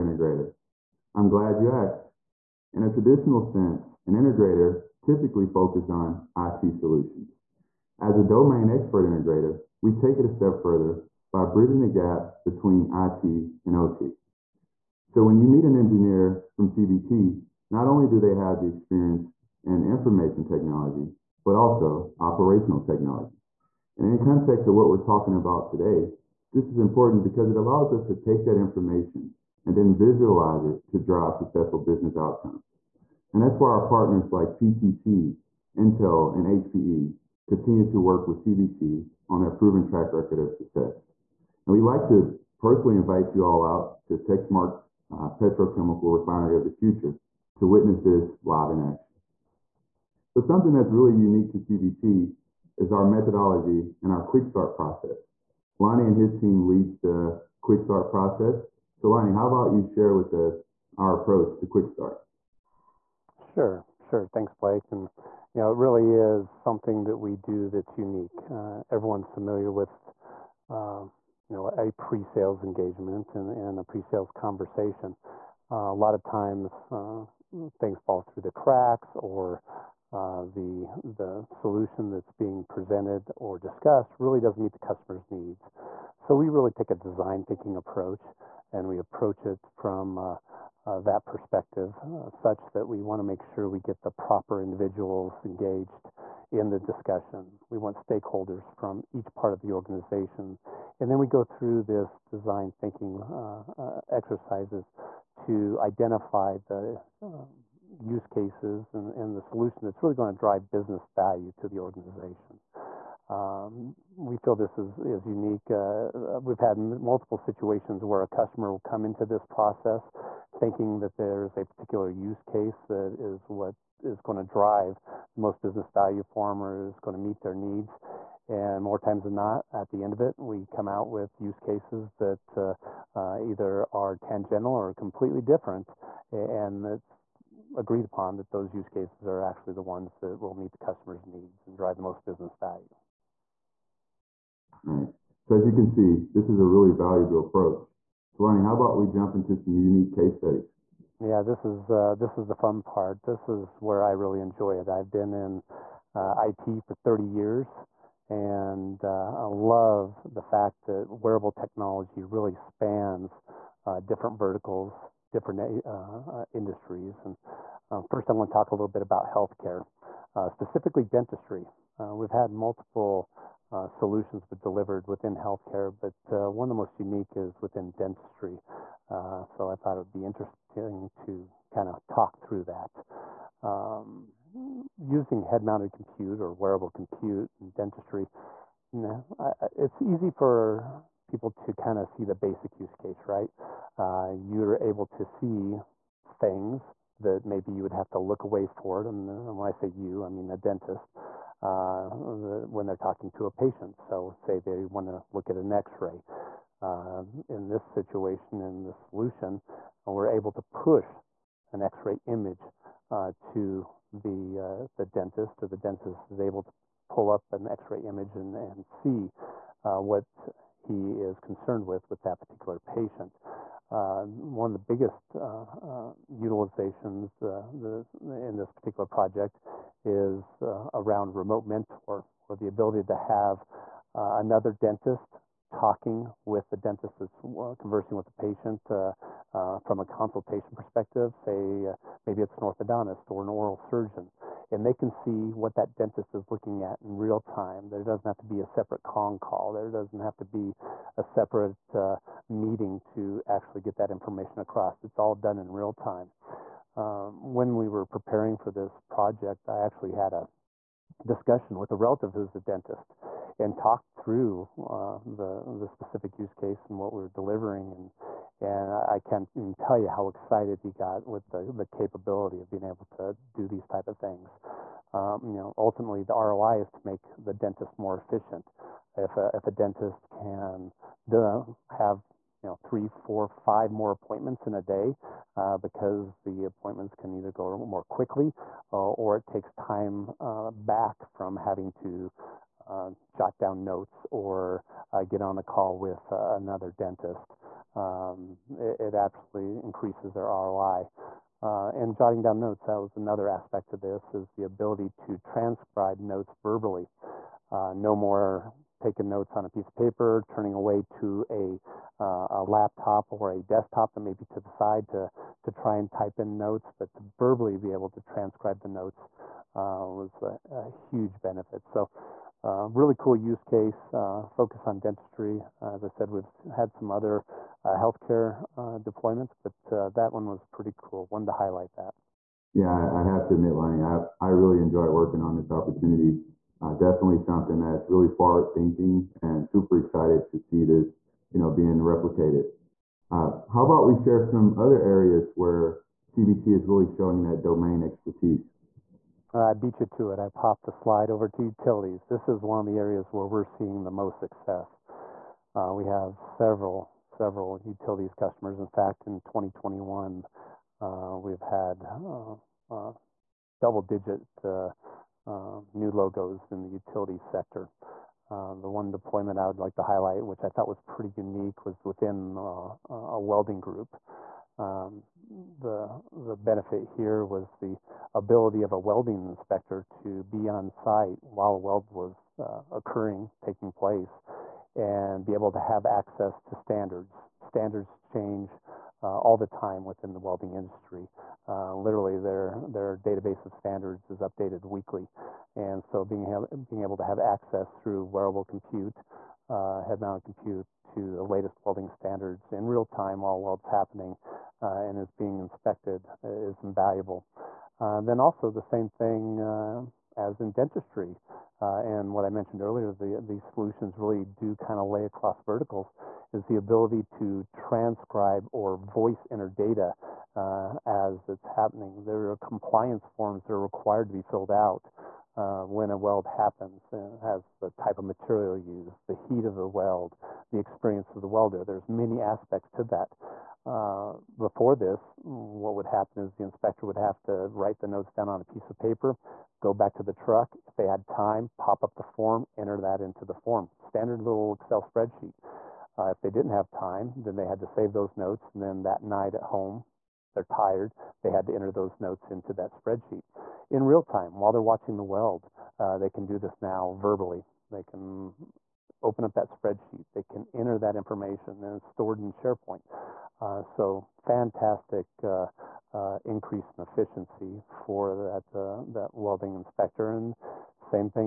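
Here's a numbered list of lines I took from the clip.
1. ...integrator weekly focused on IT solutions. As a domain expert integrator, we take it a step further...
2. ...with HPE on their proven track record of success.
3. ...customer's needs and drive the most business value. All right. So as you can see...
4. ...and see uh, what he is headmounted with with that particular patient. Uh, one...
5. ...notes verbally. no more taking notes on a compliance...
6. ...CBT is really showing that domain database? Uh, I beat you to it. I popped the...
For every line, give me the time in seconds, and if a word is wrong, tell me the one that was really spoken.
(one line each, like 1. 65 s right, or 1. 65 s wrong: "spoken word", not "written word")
1. 4 s wrong: "typically", not "weekly"
2. 38 s wrong: "CBT", not "HPE"
3. 140 s right
4. 218 s wrong: "concerned", not "headmounted"
5. 306 s wrong: "piece", not "compliance"
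6. 346 s wrong: "expertise", not "database".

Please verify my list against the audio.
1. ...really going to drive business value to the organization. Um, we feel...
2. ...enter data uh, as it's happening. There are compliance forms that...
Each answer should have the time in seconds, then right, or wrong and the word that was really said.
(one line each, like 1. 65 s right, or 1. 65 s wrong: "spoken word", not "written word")
1. 110 s right
2. 419 s right.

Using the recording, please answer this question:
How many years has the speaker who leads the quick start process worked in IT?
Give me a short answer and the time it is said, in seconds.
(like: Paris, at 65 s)
30 years, at 157 s.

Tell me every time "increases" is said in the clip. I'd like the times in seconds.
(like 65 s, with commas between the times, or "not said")
299 s, 466 s.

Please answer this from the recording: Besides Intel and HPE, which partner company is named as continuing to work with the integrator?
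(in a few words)
PTC.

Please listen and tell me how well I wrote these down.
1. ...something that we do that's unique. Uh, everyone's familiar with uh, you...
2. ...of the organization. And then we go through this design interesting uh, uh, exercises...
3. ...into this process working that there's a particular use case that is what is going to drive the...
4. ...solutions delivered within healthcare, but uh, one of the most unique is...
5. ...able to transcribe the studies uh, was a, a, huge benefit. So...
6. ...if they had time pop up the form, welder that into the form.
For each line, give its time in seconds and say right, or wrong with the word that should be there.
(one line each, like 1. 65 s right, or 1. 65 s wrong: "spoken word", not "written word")
1. 66 s right
2. 99 s wrong: "thinking", not "interesting"
3. 119 s wrong: "thinking", not "working"
4. 173 s right
5. 317 s wrong: "notes", not "studies"
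6. 440 s wrong: "enter", not "welder".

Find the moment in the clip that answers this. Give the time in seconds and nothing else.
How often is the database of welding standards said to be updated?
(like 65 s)
394 s.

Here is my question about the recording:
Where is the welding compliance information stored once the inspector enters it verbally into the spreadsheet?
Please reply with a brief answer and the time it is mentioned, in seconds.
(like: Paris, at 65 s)
SharePoint, at 462 s.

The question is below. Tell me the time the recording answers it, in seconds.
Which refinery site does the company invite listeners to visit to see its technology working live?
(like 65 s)
44 s.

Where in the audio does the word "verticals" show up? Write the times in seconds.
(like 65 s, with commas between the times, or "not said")
164 s, 415 s.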